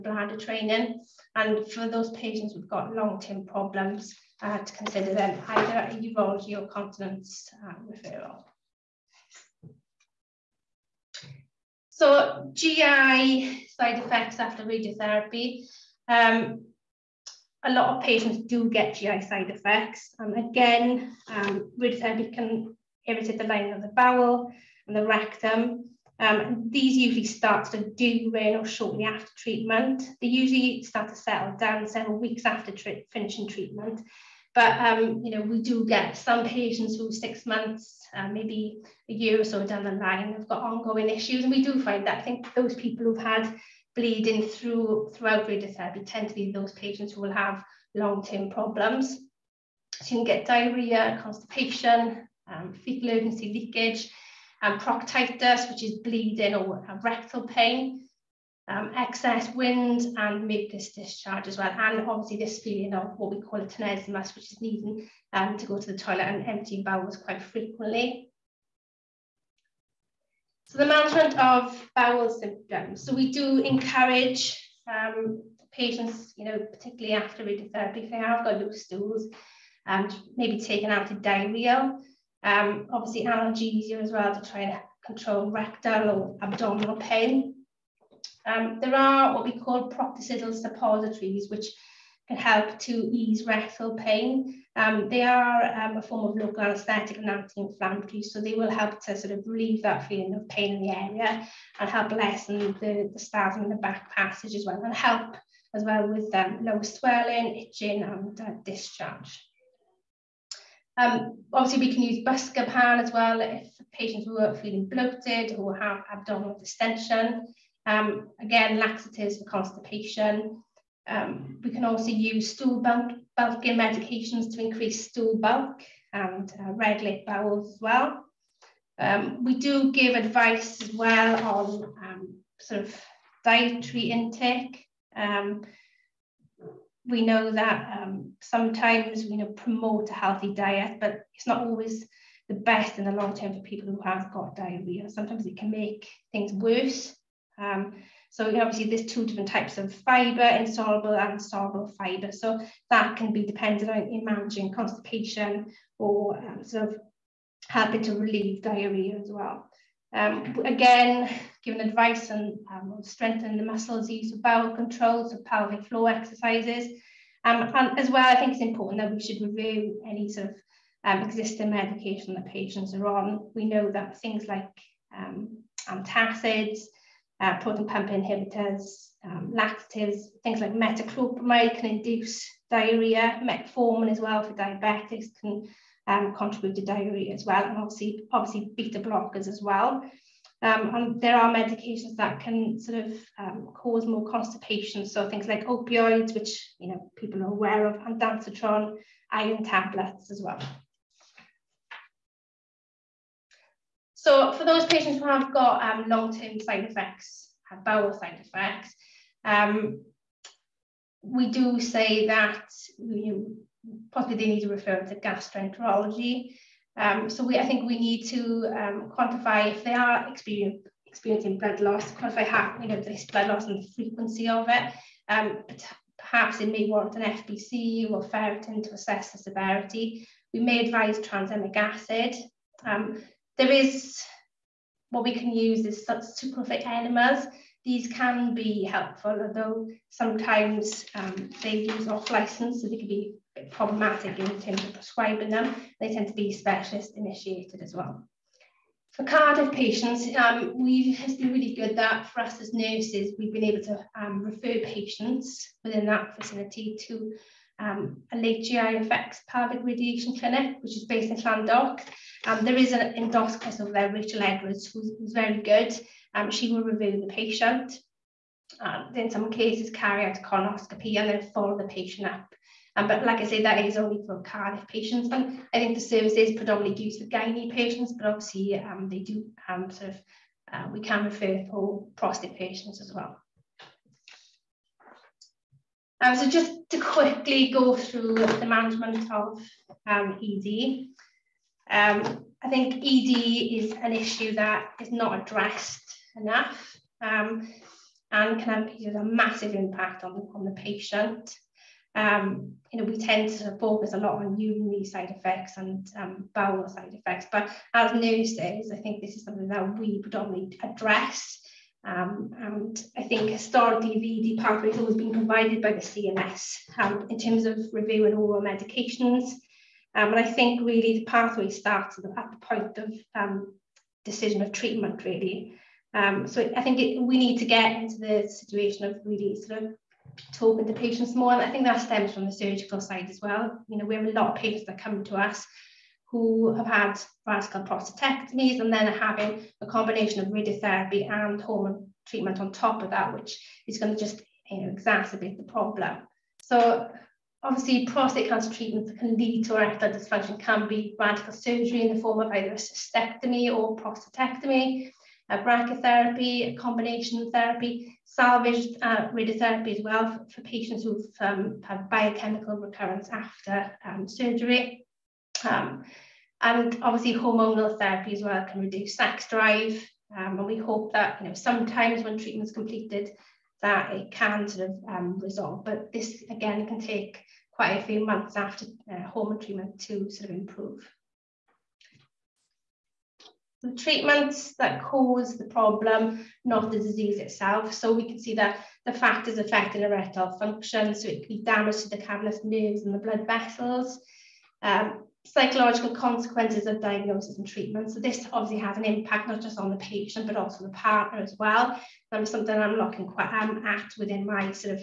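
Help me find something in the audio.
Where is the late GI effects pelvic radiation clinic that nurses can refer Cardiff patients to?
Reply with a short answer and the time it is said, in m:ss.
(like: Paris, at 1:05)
Llandough, at 4:21.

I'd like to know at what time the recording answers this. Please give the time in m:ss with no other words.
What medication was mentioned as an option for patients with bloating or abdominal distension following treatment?
1:52.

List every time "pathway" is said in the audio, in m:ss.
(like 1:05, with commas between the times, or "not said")
5:14, 5:21.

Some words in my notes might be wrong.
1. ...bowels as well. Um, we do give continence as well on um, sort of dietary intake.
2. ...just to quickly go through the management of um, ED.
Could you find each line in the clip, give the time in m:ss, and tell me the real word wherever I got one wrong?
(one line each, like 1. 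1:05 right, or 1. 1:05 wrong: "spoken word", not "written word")
1. 2:07 wrong: "advice", not "continence"
2. 4:46 right.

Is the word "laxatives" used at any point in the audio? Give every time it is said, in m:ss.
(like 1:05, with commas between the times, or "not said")
1:58, 2:59.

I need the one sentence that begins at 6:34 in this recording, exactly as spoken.
Um, psychological consequences of diagnosis and treatment.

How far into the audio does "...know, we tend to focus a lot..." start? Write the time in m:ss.
5:02.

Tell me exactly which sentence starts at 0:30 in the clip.
They usually start to settle down several weeks after finishing treatment.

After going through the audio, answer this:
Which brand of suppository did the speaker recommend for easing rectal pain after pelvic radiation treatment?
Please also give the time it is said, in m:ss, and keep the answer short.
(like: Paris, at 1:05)
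Proctosedyl, at 1:29.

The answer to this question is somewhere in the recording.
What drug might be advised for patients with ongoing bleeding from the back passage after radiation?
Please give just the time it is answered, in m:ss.
3:51.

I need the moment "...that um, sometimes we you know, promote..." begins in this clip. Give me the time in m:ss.
2:17.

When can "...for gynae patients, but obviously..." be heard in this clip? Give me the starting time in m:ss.
4:37.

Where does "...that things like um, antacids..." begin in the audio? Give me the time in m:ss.
2:53.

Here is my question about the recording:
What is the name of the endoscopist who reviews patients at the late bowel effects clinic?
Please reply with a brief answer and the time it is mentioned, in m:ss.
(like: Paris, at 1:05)
Rachel Edwards, at 4:24.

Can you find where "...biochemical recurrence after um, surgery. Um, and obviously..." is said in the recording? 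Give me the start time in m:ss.
6:02.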